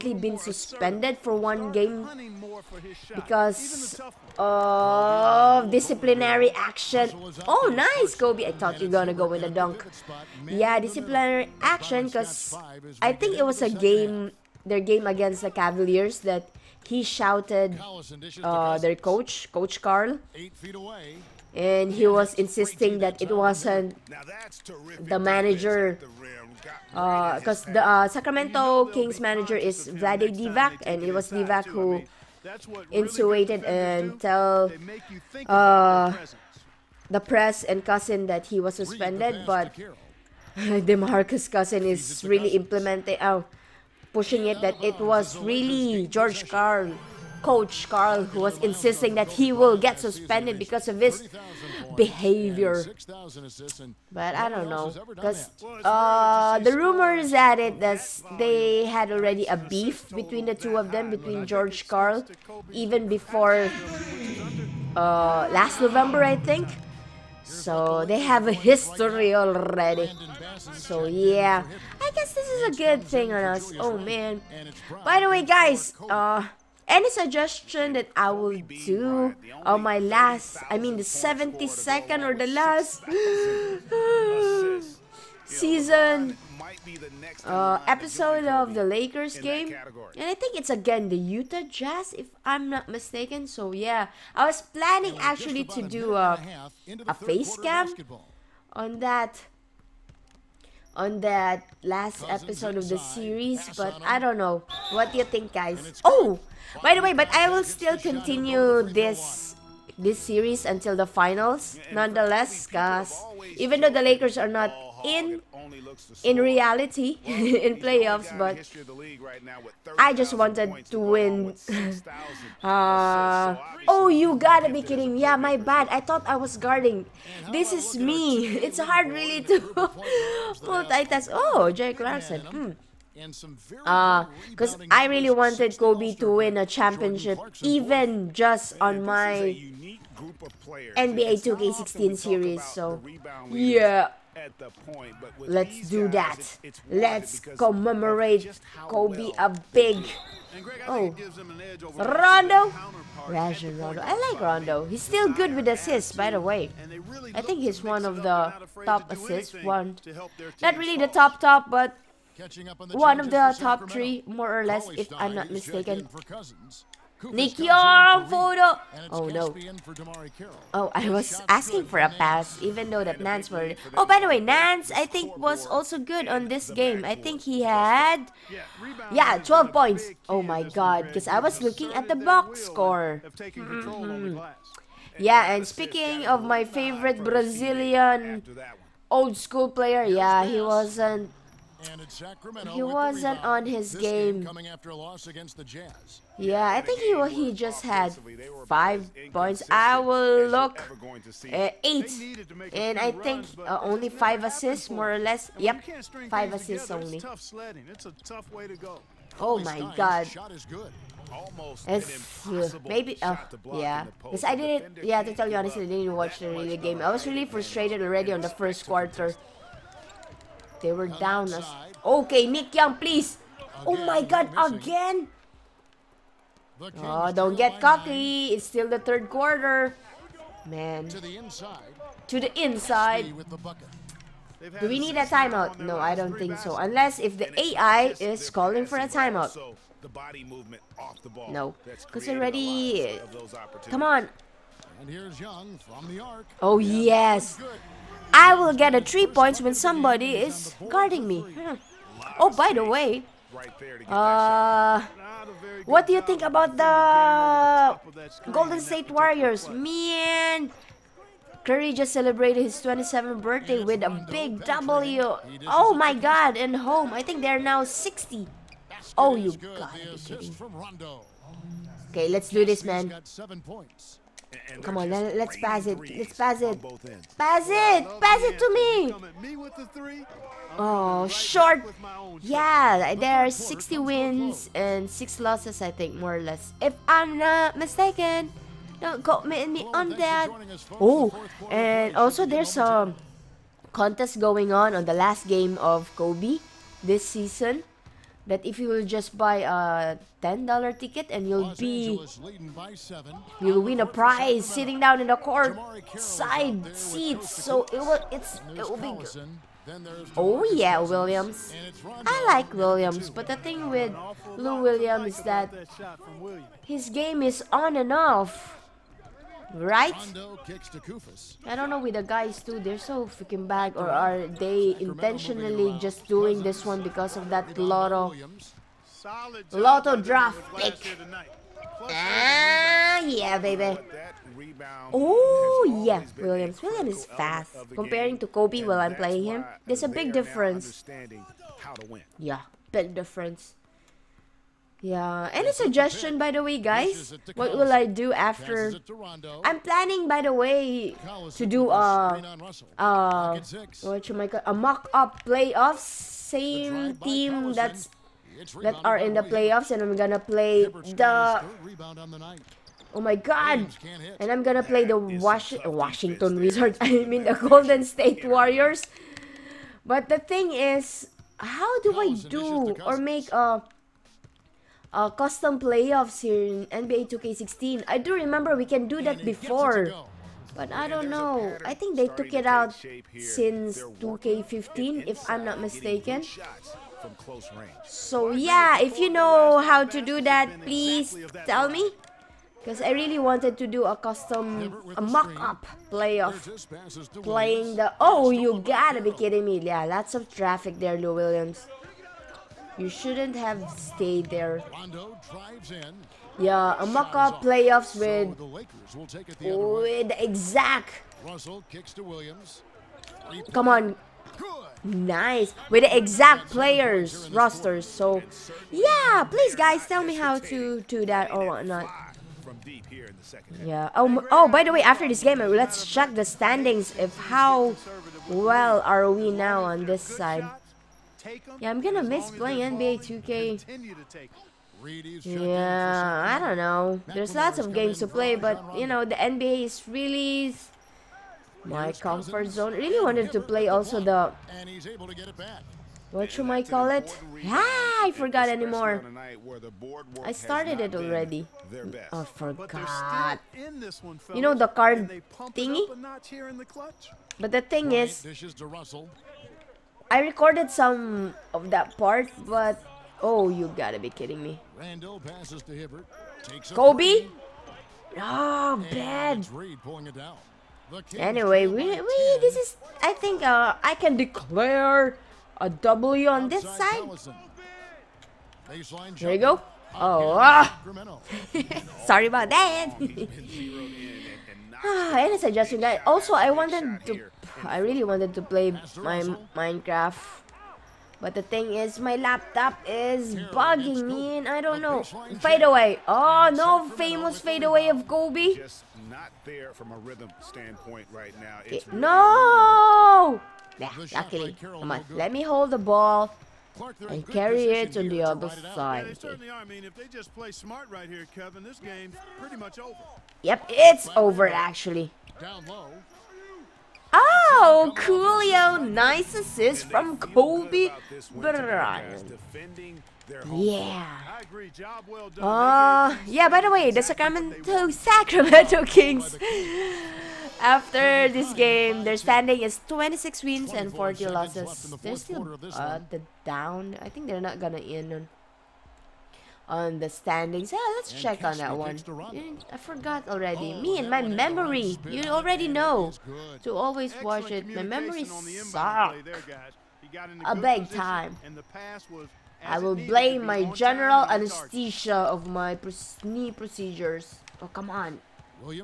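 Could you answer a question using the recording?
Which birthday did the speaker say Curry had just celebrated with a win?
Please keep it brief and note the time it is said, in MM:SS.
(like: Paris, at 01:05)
27th, at 04:22.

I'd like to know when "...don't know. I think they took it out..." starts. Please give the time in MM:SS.
06:21.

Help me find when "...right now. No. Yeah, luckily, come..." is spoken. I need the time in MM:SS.
08:21.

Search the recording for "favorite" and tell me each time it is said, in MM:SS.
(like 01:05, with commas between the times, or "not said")
03:06.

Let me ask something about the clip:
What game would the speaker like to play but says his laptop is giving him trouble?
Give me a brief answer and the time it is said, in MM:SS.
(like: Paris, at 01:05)
Minecraft, at 08:09.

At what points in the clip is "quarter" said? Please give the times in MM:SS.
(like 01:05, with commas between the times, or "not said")
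03:38, 03:49.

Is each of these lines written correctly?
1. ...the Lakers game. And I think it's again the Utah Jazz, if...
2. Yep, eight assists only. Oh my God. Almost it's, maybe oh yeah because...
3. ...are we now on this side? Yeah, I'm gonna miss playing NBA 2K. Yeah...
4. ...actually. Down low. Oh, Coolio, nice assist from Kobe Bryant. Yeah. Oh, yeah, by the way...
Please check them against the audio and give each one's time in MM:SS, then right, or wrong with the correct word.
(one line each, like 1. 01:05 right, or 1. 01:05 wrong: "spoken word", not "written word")
1. 01:28 right
2. 03:25 wrong: "five", not "eight"
3. 07:09 right
4. 08:34 right.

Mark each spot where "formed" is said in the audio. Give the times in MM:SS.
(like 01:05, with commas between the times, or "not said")
not said.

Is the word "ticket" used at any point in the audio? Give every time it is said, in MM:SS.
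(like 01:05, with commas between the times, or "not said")
05:00.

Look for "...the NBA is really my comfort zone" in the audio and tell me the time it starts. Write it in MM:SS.
07:19.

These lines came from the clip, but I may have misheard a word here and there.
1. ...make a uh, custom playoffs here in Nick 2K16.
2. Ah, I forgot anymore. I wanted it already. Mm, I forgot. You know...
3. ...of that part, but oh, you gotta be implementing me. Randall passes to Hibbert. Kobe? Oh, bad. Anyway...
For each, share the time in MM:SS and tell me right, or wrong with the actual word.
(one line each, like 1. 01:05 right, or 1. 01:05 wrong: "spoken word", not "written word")
1. 06:13 wrong: "NBA", not "Nick"
2. 07:27 wrong: "started", not "wanted"
3. 07:41 wrong: "kidding", not "implementing".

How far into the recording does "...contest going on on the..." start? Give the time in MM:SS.
04:53.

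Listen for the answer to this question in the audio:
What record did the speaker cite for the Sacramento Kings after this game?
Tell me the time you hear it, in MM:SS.
08:53.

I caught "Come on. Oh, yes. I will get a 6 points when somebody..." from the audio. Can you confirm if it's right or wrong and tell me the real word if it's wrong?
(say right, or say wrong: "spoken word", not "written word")
wrong: "3", not "6".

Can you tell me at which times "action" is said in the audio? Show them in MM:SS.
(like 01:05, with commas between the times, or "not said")
00:06, 00:11.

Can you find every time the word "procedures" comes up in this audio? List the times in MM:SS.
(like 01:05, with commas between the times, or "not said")
09:16.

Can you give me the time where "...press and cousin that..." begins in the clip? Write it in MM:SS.
00:37.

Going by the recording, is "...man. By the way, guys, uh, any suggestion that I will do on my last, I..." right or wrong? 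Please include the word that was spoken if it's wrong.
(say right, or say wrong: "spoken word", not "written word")
right.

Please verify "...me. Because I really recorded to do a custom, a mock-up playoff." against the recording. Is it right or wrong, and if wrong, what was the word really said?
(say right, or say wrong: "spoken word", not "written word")
wrong: "wanted", not "recorded".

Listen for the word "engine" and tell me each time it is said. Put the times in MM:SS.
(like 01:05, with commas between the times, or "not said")
not said.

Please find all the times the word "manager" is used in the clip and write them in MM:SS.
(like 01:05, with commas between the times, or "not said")
00:25, 00:29.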